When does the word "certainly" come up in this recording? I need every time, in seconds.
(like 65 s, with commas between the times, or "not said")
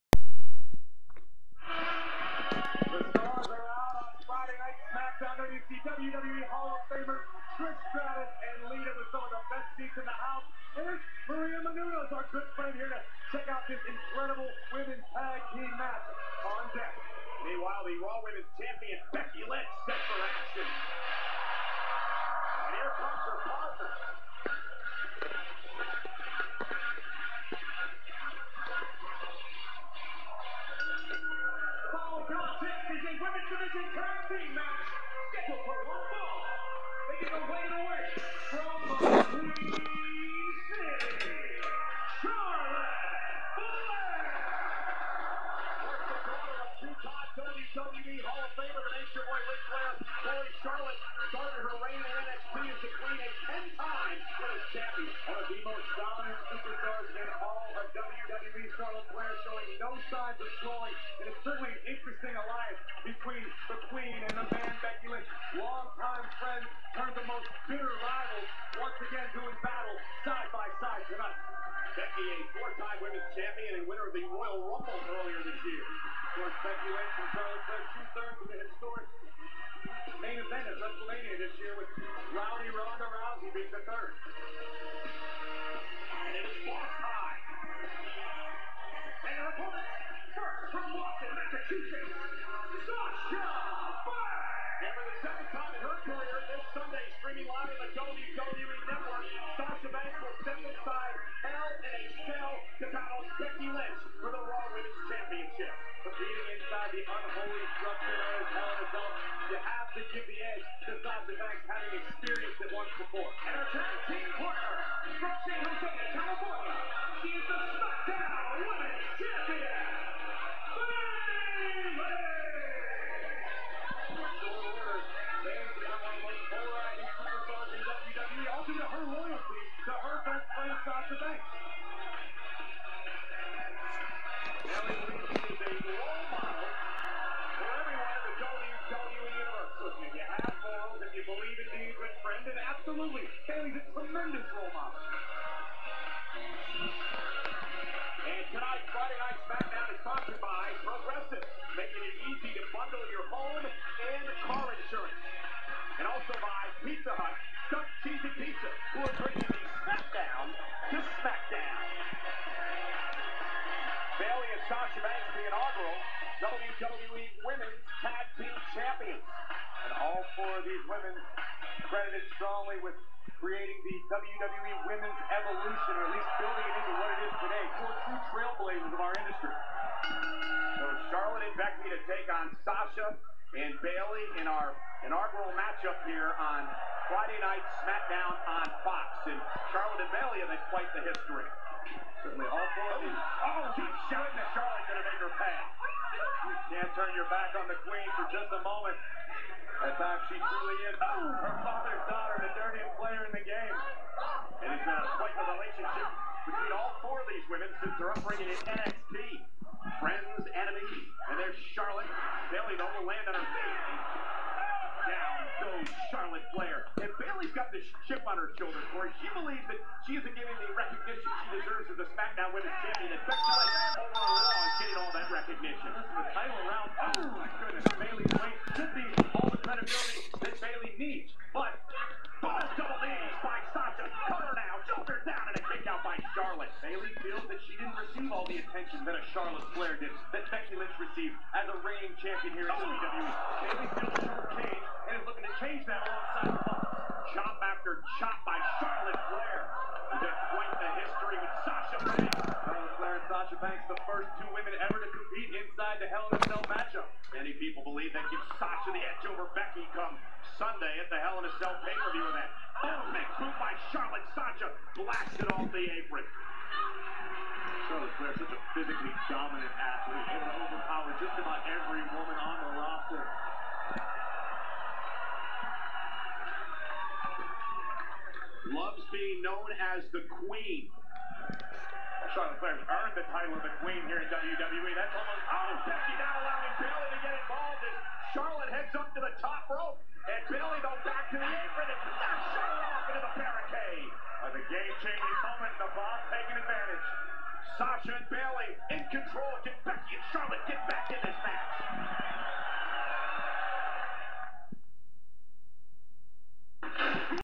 61 s, 192 s.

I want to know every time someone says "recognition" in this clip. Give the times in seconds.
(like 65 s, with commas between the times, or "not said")
220 s, 225 s.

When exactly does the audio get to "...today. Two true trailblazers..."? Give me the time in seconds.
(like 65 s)
177 s.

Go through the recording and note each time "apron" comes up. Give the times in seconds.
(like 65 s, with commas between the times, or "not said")
266 s, 291 s.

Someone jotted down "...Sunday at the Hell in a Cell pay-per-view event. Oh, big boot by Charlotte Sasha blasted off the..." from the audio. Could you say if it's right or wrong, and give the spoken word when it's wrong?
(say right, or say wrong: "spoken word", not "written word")
right.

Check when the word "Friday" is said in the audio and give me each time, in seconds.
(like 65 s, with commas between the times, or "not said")
148 s, 187 s.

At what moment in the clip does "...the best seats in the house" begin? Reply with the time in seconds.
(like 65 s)
9 s.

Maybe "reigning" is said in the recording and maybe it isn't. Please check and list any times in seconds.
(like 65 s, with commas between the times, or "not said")
241 s.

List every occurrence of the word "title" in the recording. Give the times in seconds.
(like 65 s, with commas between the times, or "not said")
226 s, 283 s.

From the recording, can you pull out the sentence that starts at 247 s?
Chop after chop by Charlotte Flair.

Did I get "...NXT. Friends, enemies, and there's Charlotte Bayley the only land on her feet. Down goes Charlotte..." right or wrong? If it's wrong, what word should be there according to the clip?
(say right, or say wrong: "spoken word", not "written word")
right.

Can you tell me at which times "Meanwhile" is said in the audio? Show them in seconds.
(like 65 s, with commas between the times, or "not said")
17 s.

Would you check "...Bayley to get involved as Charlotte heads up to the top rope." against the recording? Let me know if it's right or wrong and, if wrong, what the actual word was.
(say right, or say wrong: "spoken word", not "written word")
right.